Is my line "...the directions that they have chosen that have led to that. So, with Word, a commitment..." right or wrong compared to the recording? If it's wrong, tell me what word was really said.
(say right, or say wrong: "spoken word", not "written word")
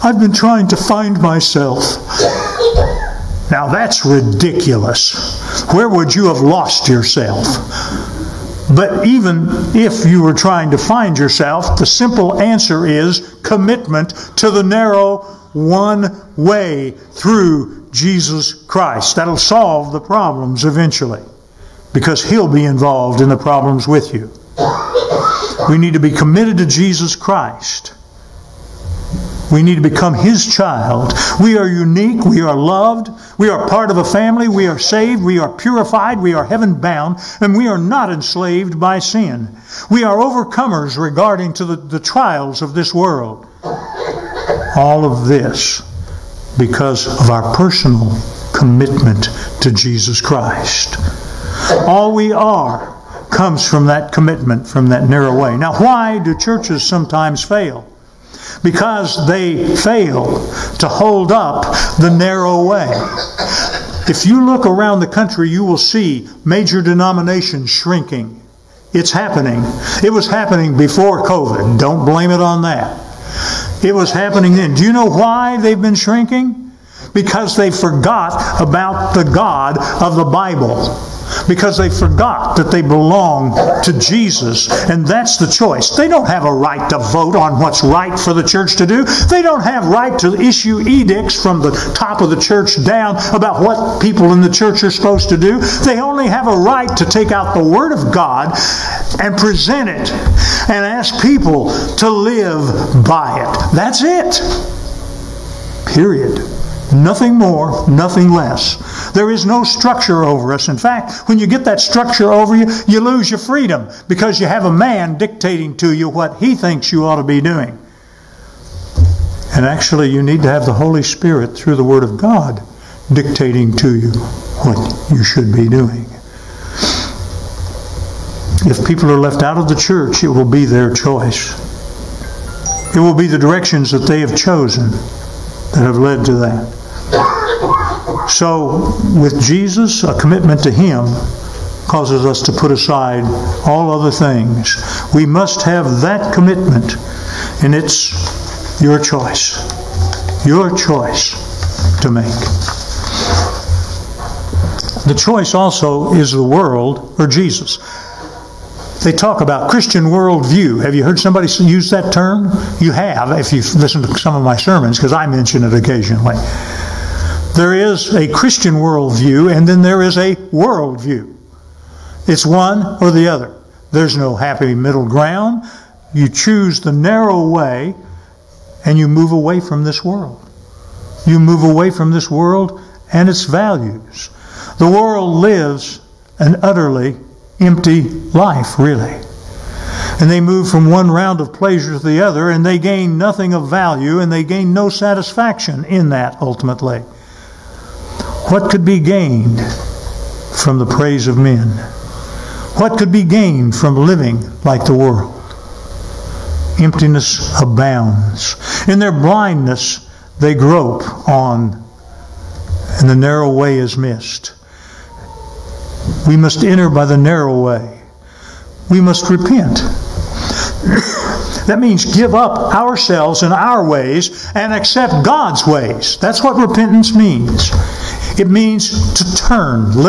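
wrong: "Jesus", not "Word".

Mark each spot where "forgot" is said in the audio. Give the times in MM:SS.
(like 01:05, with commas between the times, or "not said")
01:17, 01:21.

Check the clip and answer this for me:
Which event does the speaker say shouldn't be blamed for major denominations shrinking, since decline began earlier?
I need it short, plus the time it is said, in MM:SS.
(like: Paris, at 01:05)
COVID, at 01:11.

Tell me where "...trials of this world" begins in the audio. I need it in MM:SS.
00:41.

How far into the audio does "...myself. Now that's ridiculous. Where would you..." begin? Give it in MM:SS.
00:01.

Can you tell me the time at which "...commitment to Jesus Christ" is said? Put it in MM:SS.
00:48.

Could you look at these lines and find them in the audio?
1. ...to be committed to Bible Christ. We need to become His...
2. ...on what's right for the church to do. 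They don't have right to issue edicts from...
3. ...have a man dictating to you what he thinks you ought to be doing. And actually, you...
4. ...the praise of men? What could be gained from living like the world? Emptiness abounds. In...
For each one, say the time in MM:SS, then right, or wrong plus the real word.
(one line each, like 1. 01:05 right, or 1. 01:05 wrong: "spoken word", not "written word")
1. 00:25 wrong: "Jesus", not "Bible"
2. 01:27 right
3. 01:54 right
4. 03:20 right.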